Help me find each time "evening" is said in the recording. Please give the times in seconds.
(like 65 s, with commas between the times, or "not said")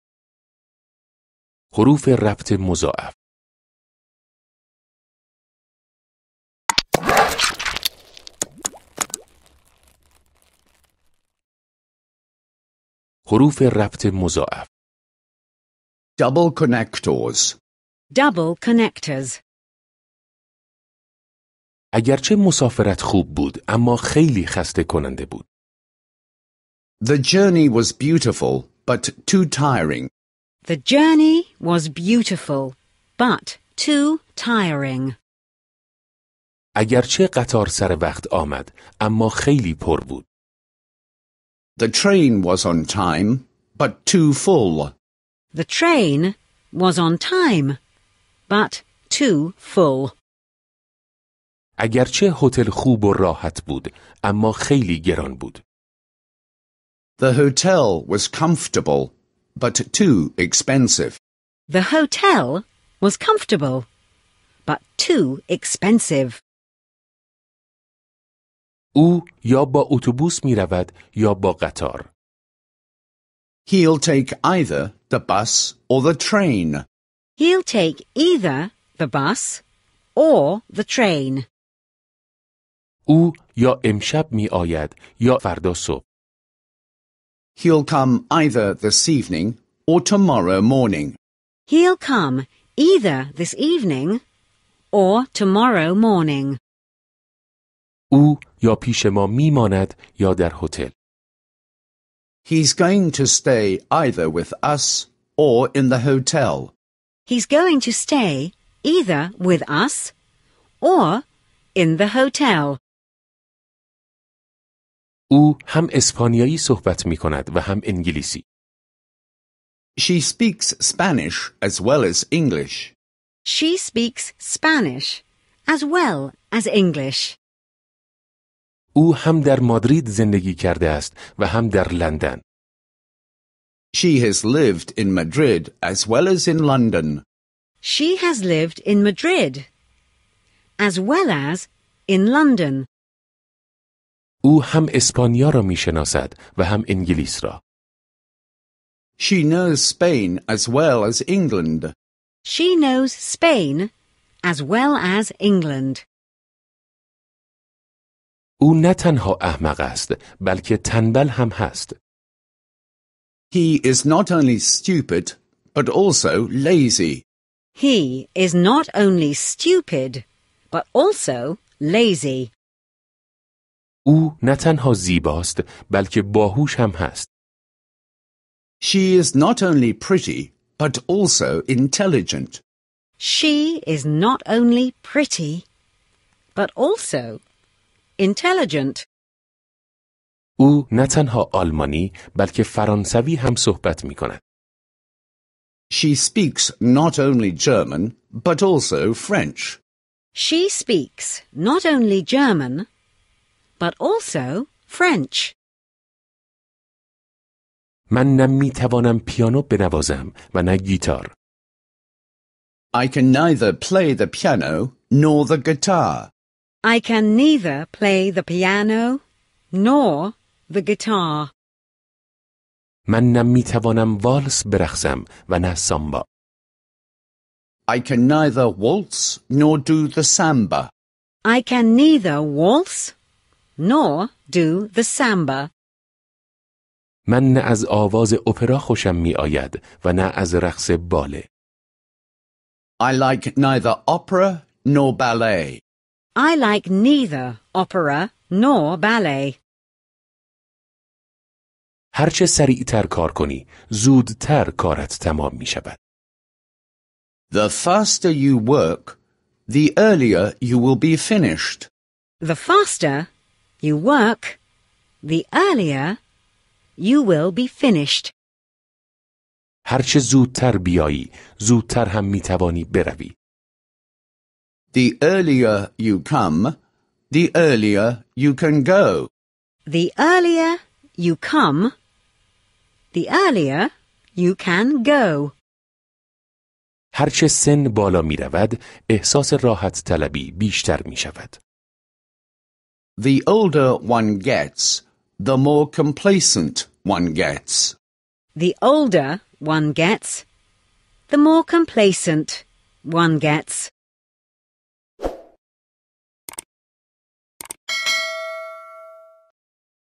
89 s, 93 s.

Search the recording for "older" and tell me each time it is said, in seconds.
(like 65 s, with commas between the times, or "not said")
293 s, 298 s.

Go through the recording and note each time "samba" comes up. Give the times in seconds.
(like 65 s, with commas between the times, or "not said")
230 s, 235 s.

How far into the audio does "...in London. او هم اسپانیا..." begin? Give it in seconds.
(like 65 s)
142 s.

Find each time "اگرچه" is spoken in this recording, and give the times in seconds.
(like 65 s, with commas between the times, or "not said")
21 s, 36 s, 51 s.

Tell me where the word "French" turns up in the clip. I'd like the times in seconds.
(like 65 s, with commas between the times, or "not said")
199 s, 204 s.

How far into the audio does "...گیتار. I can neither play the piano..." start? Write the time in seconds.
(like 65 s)
210 s.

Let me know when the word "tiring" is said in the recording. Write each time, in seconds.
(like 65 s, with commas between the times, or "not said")
29 s, 34 s.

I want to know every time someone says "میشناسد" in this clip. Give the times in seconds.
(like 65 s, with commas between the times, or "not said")
145 s.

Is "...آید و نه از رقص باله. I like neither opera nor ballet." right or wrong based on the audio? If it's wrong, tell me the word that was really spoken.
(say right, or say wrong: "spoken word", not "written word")
right.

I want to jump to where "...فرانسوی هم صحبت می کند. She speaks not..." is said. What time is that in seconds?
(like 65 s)
192 s.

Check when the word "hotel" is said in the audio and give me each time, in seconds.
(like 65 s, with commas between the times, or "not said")
57 s, 61 s, 105 s, 112 s.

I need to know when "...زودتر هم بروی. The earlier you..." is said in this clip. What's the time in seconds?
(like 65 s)
271 s.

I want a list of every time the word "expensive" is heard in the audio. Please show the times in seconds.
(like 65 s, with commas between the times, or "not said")
60 s, 65 s.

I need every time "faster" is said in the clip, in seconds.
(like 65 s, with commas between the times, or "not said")
257 s, 262 s.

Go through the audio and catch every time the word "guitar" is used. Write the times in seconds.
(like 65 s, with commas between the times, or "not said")
215 s, 220 s.